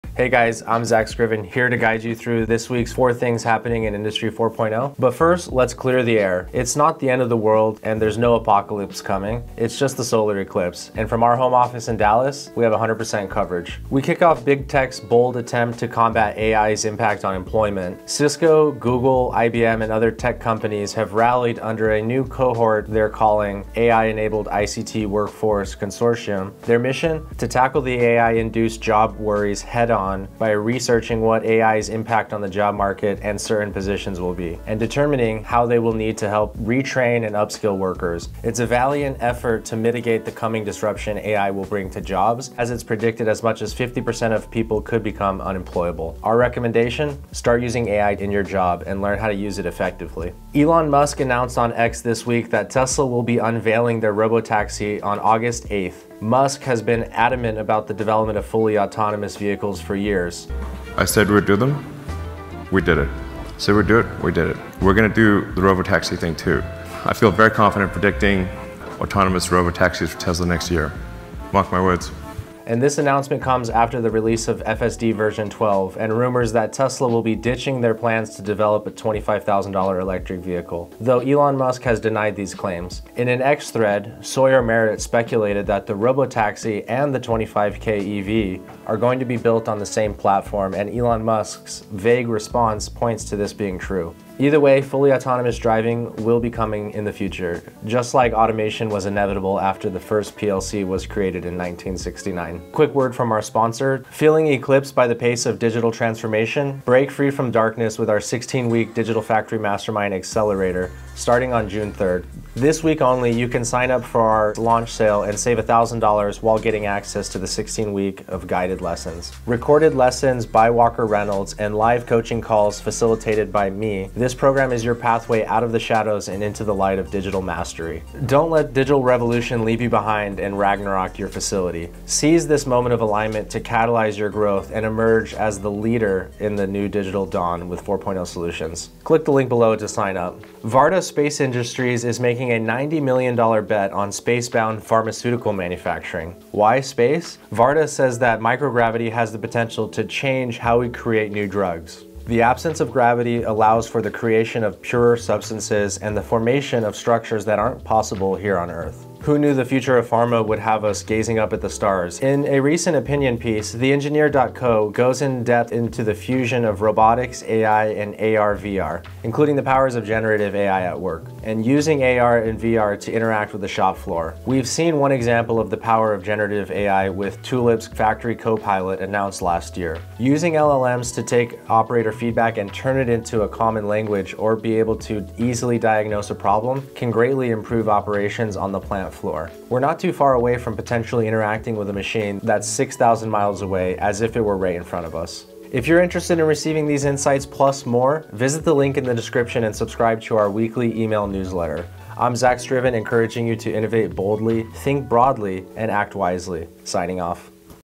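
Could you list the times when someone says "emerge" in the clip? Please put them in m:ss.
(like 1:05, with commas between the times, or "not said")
2:14.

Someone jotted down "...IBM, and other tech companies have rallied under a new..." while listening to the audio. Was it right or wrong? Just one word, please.
right.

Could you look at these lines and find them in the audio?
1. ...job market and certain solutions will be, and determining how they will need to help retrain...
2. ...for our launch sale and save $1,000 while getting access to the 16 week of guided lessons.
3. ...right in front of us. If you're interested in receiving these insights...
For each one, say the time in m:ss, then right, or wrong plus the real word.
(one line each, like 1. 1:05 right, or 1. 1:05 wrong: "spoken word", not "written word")
1. 0:32 wrong: "positions", not "solutions"
2. 1:54 right
3. 3:14 right.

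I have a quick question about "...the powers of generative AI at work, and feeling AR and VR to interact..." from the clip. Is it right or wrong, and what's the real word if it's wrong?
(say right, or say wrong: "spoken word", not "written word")
wrong: "using", not "feeling".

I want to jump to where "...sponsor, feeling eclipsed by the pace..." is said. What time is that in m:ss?
1:43.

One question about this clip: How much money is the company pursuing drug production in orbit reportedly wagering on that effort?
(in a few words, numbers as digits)
$90 million.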